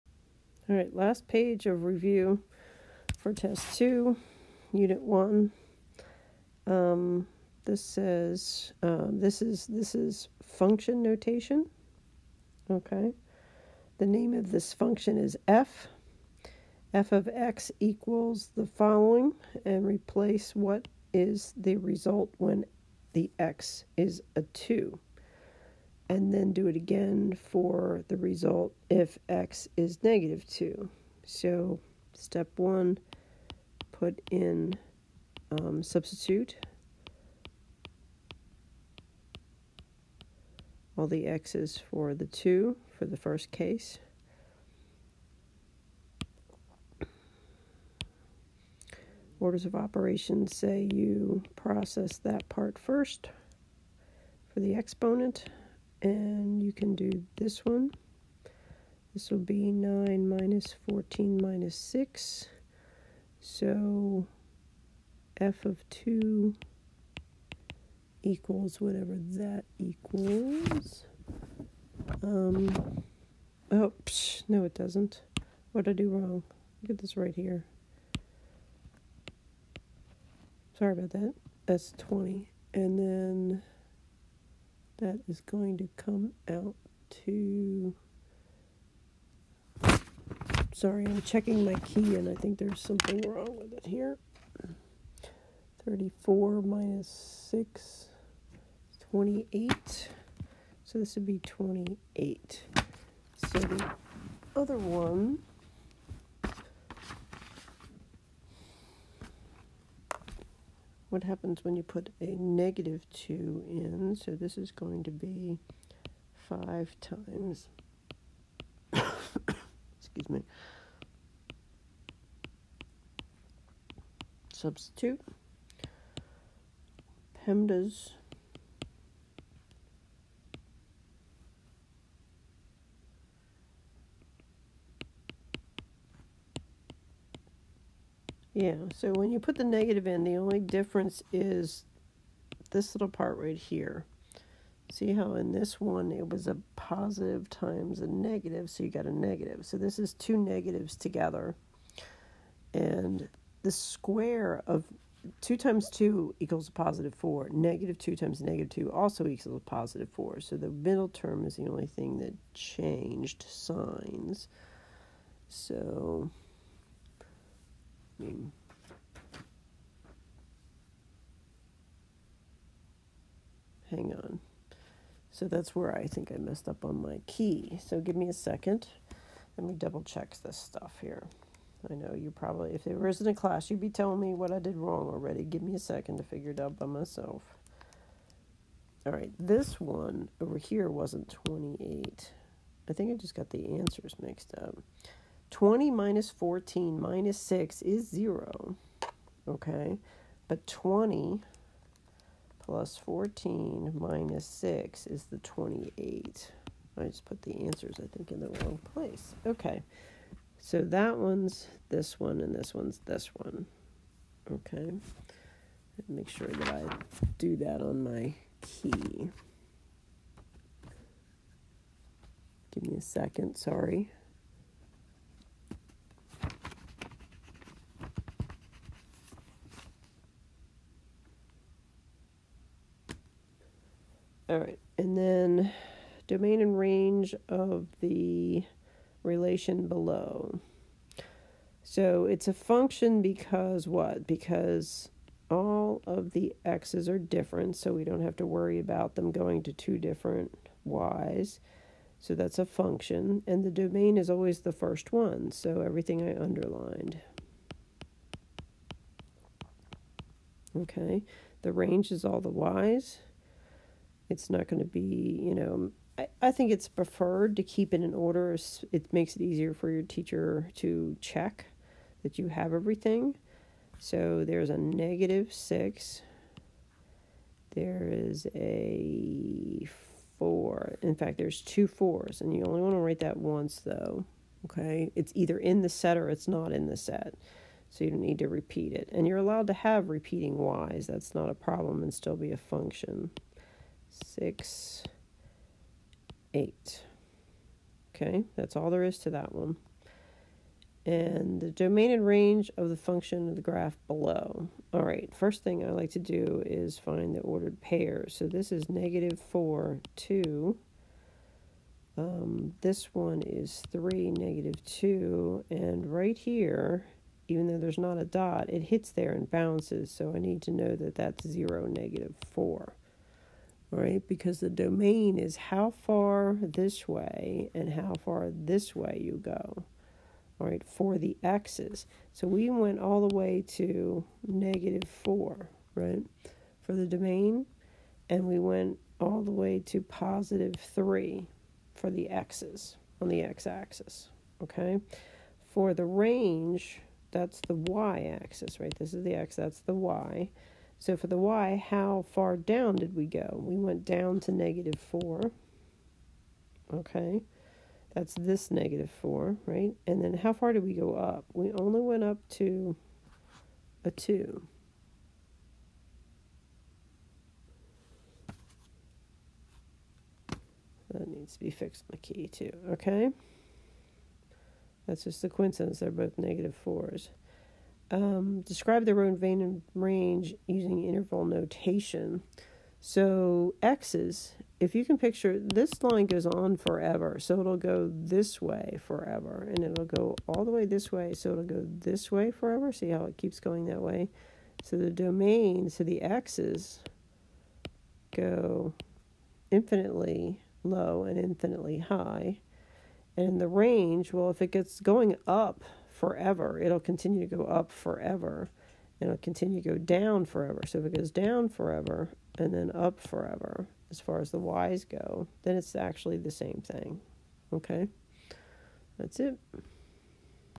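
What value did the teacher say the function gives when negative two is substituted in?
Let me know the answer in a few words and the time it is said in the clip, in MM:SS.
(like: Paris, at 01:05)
28, at 03:25.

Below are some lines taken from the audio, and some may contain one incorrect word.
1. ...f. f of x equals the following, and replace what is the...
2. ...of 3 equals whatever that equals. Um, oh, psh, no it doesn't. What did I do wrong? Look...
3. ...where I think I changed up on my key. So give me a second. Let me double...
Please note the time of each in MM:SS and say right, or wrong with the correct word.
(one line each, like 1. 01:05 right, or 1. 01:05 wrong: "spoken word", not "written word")
1. 00:15 right
2. 01:05 wrong: "2", not "3"
3. 02:55 wrong: "messed", not "changed".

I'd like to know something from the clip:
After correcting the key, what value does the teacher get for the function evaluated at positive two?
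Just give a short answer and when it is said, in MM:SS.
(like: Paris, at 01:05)
0, at 03:17.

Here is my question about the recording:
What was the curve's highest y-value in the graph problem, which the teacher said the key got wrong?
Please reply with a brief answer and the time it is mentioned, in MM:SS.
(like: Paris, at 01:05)
2, at 06:04.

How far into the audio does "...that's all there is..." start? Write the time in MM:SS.
04:58.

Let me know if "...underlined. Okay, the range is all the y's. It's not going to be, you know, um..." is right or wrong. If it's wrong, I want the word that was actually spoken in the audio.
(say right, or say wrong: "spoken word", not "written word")
right.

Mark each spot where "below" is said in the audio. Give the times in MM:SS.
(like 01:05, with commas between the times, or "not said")
03:59, 05:04.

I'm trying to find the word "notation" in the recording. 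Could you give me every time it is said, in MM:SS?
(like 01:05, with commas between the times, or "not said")
00:11, 06:21.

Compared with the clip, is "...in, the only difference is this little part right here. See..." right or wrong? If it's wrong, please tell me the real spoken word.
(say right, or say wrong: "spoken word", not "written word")
right.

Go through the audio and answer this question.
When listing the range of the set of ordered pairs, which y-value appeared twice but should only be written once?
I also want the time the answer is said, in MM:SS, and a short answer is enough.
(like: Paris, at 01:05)
4, at 04:41.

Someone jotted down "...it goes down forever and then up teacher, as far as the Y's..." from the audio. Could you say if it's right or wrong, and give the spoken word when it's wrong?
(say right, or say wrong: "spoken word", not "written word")
wrong: "forever", not "teacher".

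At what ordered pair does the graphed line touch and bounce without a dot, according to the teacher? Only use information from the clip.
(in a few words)
(0, -4).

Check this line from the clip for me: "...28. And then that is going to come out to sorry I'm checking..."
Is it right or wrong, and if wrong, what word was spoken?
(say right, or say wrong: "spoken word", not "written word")
wrong: "20", not "28".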